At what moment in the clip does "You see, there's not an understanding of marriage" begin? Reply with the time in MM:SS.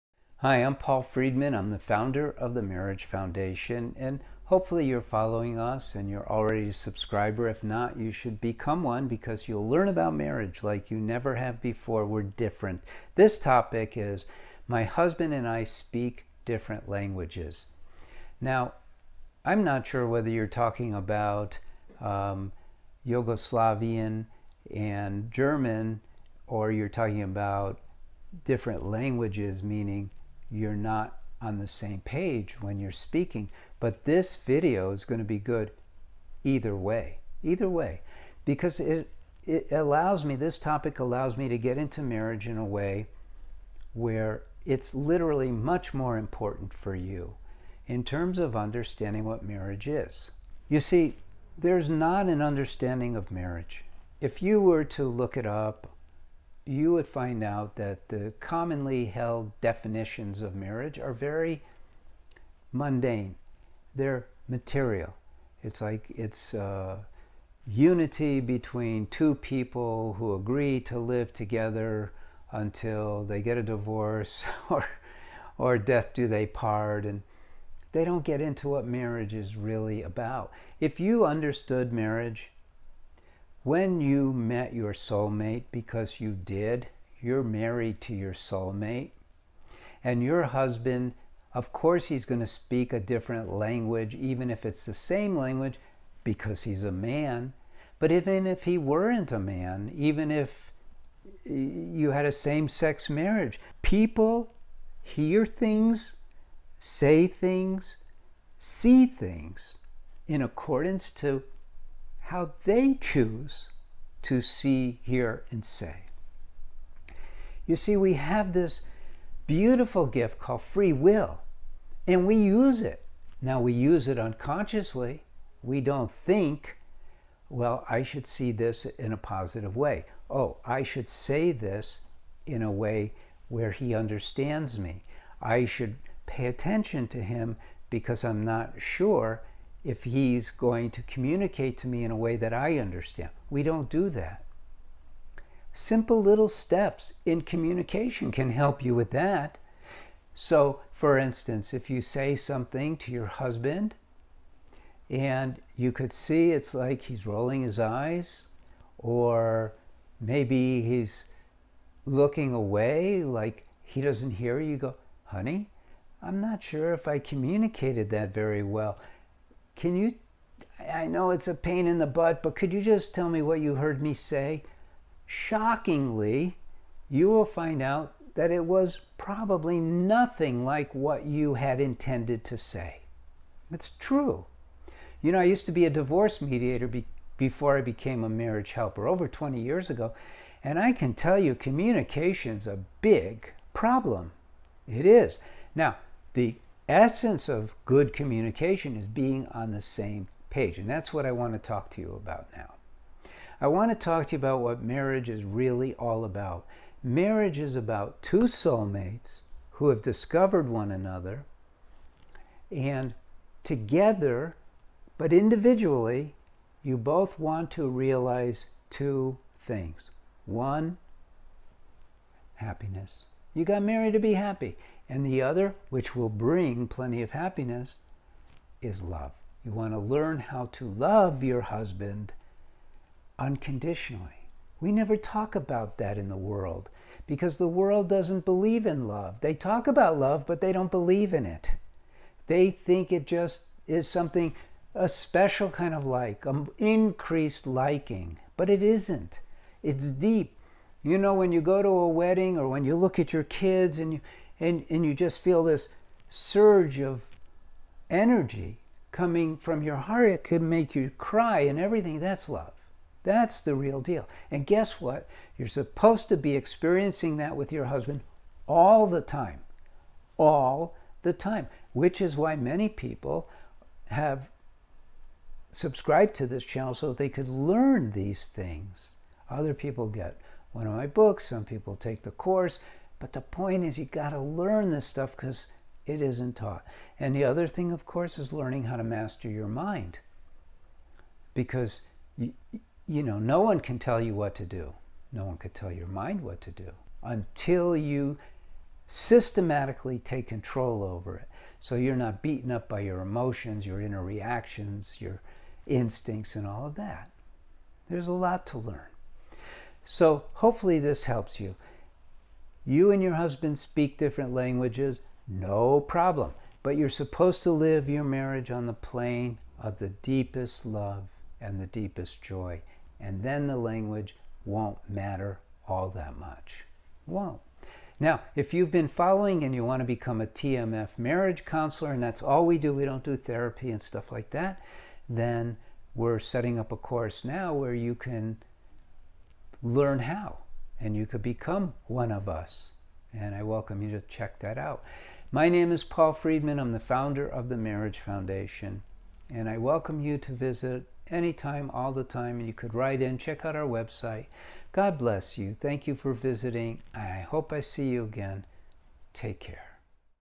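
00:50.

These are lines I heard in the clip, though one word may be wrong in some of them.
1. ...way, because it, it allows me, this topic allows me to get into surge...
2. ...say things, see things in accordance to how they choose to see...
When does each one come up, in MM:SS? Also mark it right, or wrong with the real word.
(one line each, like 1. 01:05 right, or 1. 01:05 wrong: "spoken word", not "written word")
1. 00:37 wrong: "marriage", not "surge"
2. 01:46 right.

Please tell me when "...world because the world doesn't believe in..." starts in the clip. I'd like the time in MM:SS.
03:56.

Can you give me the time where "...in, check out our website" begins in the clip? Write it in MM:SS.
05:53.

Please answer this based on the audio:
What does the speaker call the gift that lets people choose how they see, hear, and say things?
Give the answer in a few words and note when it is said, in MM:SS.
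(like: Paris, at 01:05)
Free will, at 02:00.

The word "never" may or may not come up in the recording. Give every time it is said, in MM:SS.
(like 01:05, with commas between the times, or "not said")
00:10, 03:54.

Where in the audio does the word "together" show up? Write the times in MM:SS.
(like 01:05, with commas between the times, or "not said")
01:11, 03:33.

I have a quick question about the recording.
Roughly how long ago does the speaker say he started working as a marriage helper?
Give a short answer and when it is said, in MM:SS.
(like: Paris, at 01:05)
Over 20 years, at 03:09.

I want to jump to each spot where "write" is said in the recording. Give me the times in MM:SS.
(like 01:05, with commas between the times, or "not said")
05:52.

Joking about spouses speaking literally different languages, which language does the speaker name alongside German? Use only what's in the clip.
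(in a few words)
Yugoslavian.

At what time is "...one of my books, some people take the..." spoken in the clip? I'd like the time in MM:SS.
04:40.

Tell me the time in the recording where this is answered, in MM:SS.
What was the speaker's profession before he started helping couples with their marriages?
03:05.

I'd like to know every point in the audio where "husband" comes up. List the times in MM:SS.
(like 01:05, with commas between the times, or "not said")
00:14, 01:30, 02:33, 03:51, 04:27, 05:13.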